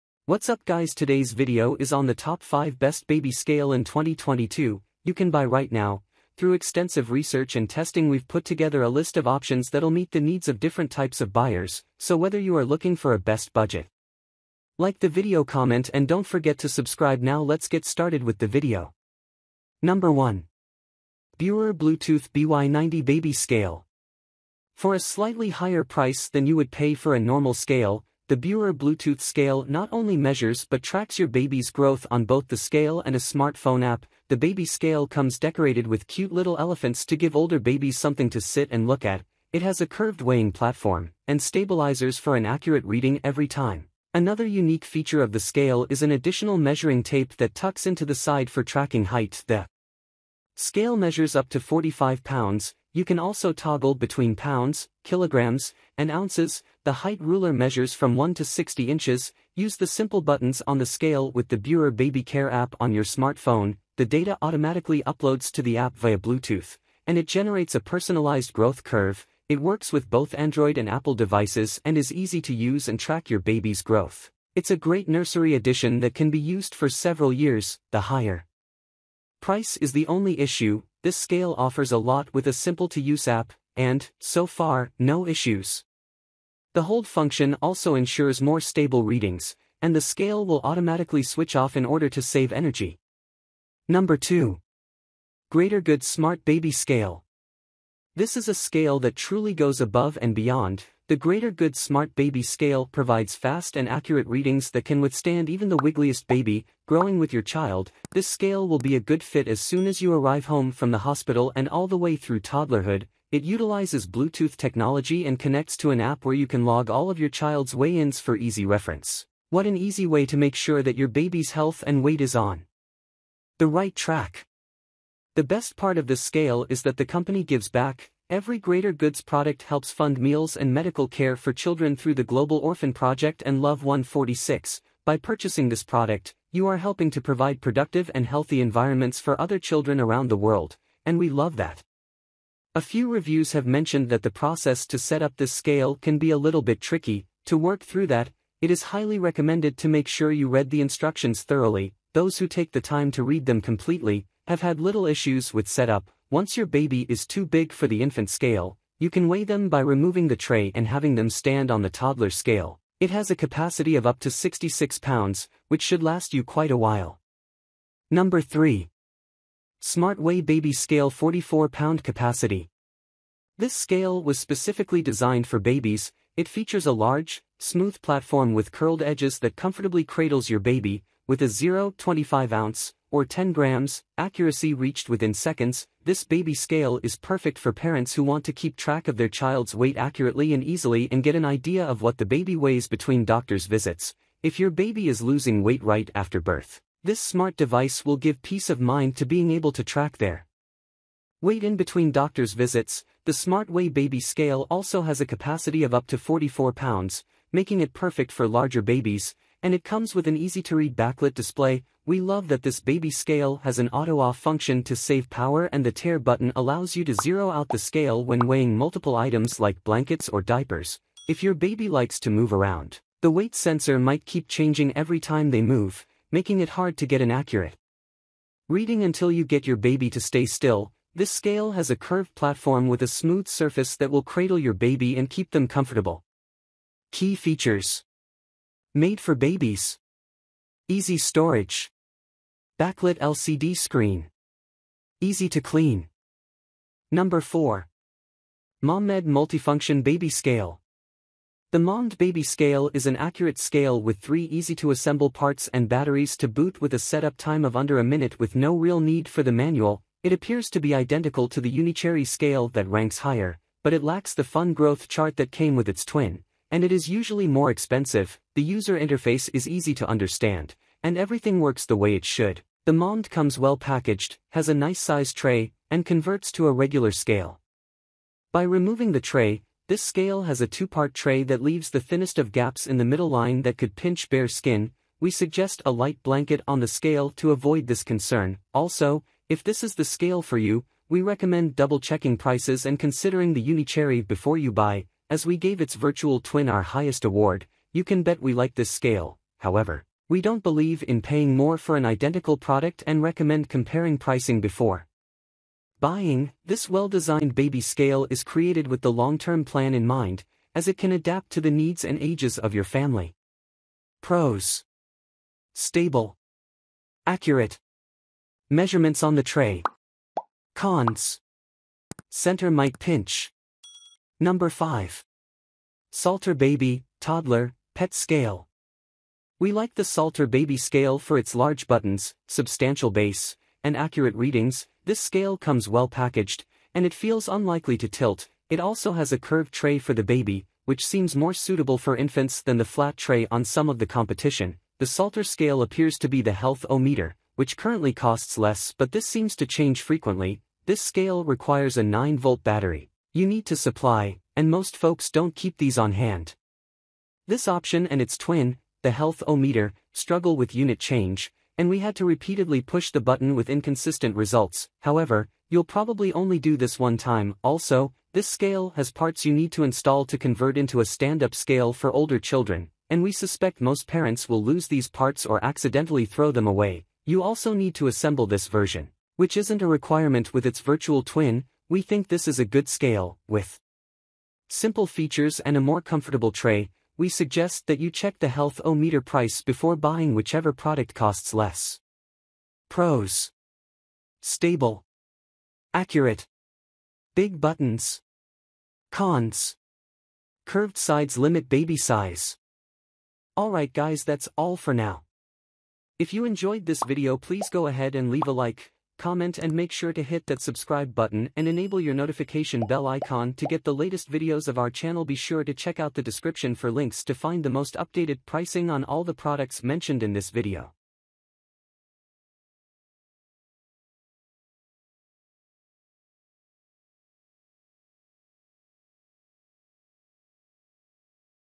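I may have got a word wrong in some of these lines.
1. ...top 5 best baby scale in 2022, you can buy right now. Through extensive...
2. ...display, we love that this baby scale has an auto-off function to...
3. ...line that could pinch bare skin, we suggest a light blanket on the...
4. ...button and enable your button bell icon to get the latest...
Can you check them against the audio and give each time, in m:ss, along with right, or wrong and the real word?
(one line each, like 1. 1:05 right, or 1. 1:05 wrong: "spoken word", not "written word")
1. 0:02 right
2. 3:31 right
3. 4:43 right
4. 6:51 wrong: "notification", not "button".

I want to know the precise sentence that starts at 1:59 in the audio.
What an easy way to make sure that your baby's health and weight is on the right track.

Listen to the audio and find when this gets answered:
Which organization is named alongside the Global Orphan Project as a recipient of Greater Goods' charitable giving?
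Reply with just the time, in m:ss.
2:13.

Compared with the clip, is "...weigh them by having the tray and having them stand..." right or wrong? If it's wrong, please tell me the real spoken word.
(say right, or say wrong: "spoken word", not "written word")
wrong: "removing", not "having".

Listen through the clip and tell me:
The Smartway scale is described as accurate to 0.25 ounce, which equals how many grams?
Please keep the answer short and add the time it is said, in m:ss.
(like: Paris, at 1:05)
10 grams, at 3:03.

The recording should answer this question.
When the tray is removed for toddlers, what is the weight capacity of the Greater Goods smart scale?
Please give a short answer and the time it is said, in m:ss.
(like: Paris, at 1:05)
66 pounds, at 2:44.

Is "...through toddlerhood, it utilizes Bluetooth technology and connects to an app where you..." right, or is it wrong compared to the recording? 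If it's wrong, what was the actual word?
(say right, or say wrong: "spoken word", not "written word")
right.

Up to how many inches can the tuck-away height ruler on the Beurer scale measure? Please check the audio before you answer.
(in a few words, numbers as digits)
60 inches.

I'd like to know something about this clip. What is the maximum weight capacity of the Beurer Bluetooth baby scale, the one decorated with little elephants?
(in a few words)
45 pounds.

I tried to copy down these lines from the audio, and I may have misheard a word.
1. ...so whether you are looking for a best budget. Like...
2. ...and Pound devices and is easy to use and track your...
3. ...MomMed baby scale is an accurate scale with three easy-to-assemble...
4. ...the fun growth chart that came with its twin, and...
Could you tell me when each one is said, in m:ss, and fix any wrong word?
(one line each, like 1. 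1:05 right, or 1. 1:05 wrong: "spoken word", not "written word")
1. 0:11 right
2. 1:10 wrong: "Apple", not "Pound"
3. 4:11 right
4. 4:24 right.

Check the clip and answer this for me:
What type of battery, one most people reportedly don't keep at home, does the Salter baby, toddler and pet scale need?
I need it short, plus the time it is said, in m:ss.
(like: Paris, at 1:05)
9-volt battery, at 5:52.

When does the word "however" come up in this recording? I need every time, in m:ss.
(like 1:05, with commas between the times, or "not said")
4:59, 6:04.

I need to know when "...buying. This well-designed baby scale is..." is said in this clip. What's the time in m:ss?
5:06.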